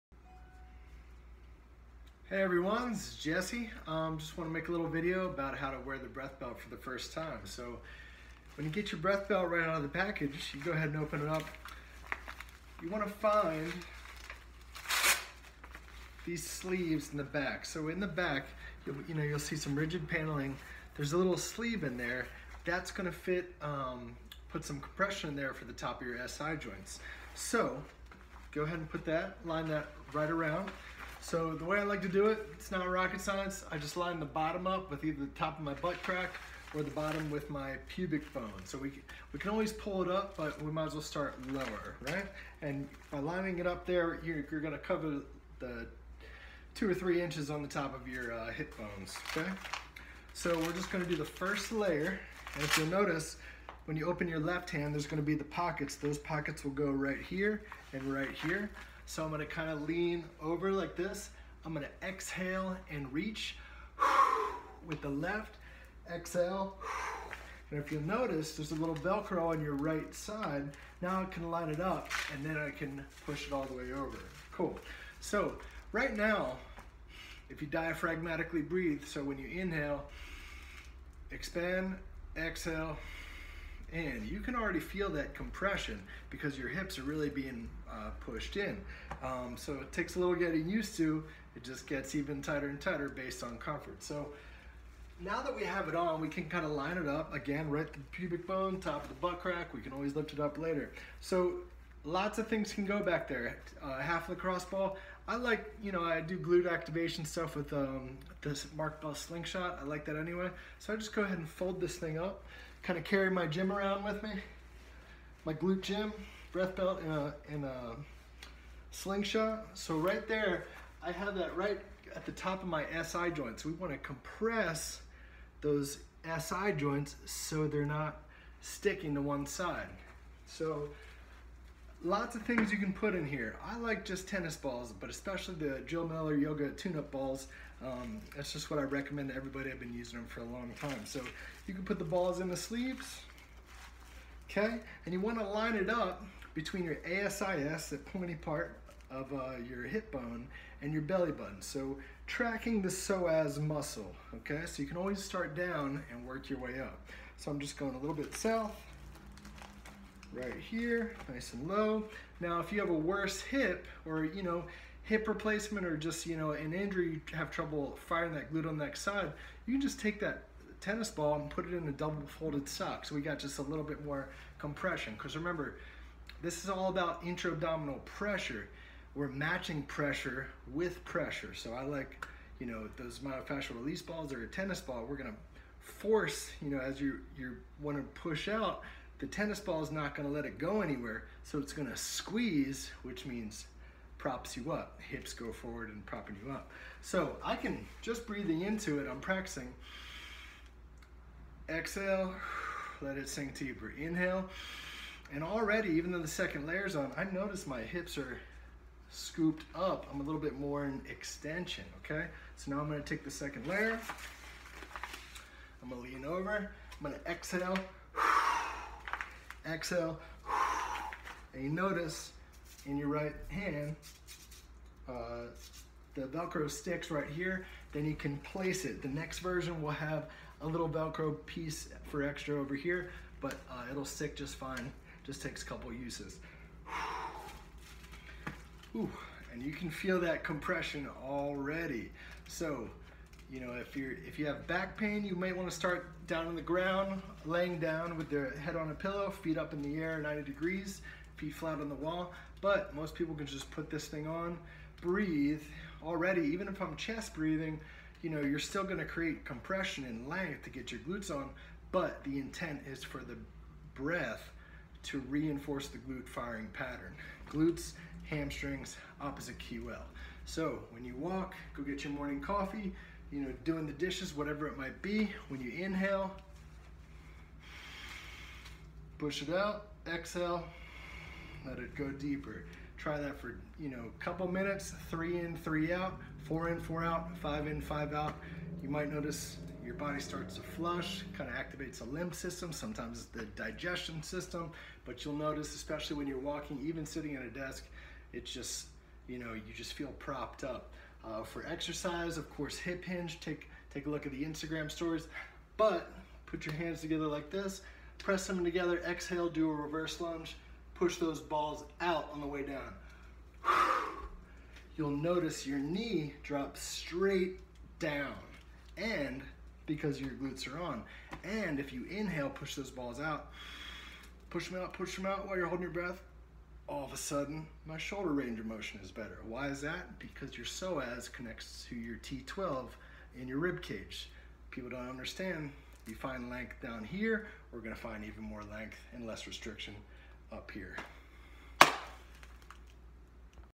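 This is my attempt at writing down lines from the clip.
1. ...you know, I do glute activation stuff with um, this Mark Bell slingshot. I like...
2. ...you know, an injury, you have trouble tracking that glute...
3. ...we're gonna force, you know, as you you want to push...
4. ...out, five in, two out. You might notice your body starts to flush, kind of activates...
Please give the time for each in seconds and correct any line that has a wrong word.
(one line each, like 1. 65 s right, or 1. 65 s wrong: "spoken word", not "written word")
1. 105 s right
2. 166 s wrong: "firing", not "tracking"
3. 185 s right
4. 287 s wrong: "five", not "two".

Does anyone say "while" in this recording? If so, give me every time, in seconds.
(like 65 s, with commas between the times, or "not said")
325 s.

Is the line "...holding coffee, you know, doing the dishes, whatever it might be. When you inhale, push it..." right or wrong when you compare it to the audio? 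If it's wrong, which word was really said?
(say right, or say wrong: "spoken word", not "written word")
wrong: "morning", not "holding".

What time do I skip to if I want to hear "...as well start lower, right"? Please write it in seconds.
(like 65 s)
40 s.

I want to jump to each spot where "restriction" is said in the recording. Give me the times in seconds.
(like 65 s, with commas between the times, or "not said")
339 s.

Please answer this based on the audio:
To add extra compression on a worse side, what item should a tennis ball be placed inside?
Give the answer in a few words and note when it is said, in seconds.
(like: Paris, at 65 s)
double folded sock, at 171 s.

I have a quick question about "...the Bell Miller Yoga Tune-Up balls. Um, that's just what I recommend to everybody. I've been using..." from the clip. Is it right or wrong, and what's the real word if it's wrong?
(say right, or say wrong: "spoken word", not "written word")
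wrong: "Jill", not "Bell".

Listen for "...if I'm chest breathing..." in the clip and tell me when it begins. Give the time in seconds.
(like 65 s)
256 s.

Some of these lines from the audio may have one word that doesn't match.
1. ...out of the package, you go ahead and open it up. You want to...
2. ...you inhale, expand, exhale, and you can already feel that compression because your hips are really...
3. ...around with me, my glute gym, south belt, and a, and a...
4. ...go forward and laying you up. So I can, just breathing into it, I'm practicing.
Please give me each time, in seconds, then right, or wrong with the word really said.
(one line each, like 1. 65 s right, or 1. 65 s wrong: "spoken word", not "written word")
1. 9 s right
2. 79 s right
3. 113 s wrong: "breath", not "south"
4. 195 s wrong: "propping", not "laying".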